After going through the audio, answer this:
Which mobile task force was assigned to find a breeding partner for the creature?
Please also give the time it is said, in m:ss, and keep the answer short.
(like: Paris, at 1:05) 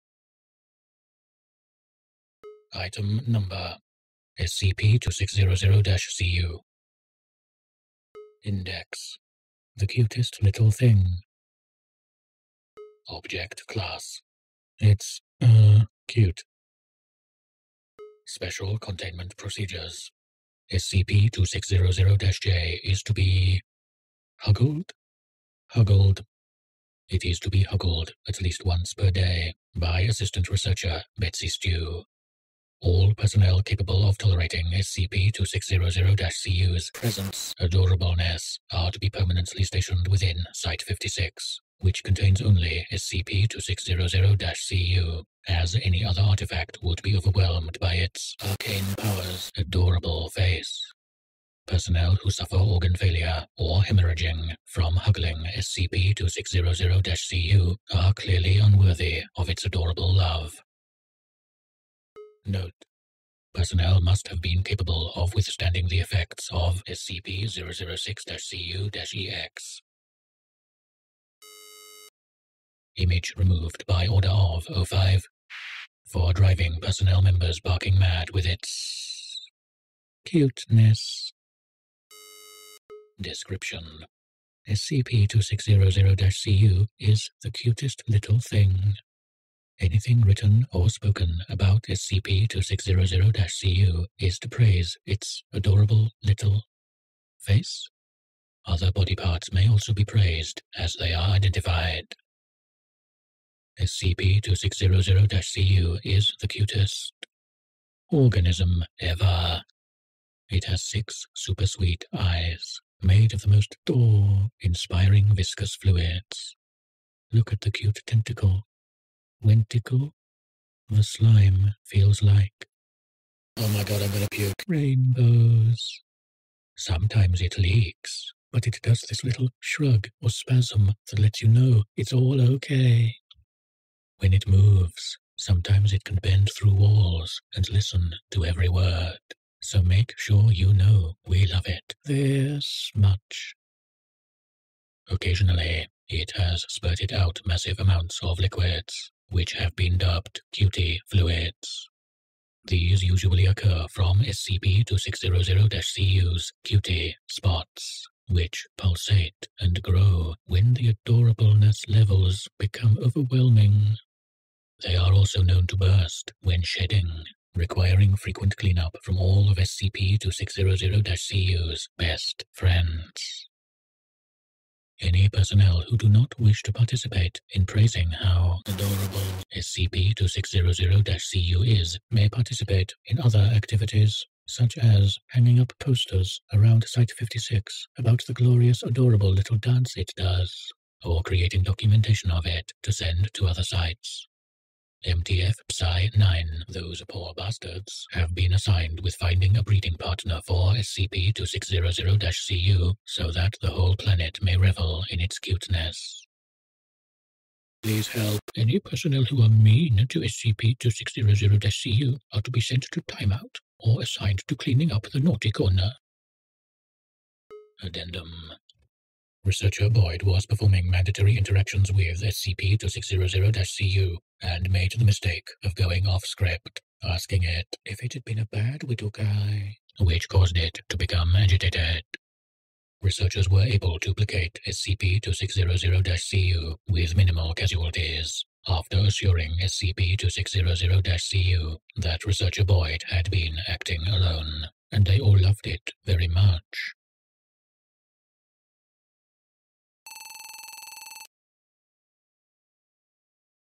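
MTF Psi 9, at 3:15.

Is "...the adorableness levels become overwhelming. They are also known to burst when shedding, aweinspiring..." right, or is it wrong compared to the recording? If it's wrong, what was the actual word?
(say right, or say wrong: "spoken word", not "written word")
wrong: "requiring", not "aweinspiring".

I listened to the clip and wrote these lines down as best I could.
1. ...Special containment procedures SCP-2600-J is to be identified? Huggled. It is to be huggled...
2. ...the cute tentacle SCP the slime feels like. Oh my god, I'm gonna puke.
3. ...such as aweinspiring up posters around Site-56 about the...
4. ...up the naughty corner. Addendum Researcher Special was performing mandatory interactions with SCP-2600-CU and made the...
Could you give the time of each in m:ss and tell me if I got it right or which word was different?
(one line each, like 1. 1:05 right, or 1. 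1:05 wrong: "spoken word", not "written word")
1. 0:18 wrong: "huggled", not "identified"
2. 1:57 wrong: "Tentacle", not "SCP"
3. 3:04 wrong: "hanging", not "aweinspiring"
4. 3:34 wrong: "Boyd", not "Special".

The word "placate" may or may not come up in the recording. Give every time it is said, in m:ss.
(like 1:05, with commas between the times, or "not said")
3:54.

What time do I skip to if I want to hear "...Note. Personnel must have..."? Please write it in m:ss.
1:02.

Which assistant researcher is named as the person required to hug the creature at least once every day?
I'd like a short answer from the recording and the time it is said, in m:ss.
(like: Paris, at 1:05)
Betsy Stew, at 0:31.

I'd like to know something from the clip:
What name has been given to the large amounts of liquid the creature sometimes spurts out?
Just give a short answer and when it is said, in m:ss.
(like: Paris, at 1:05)
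QT fluids, at 2:30.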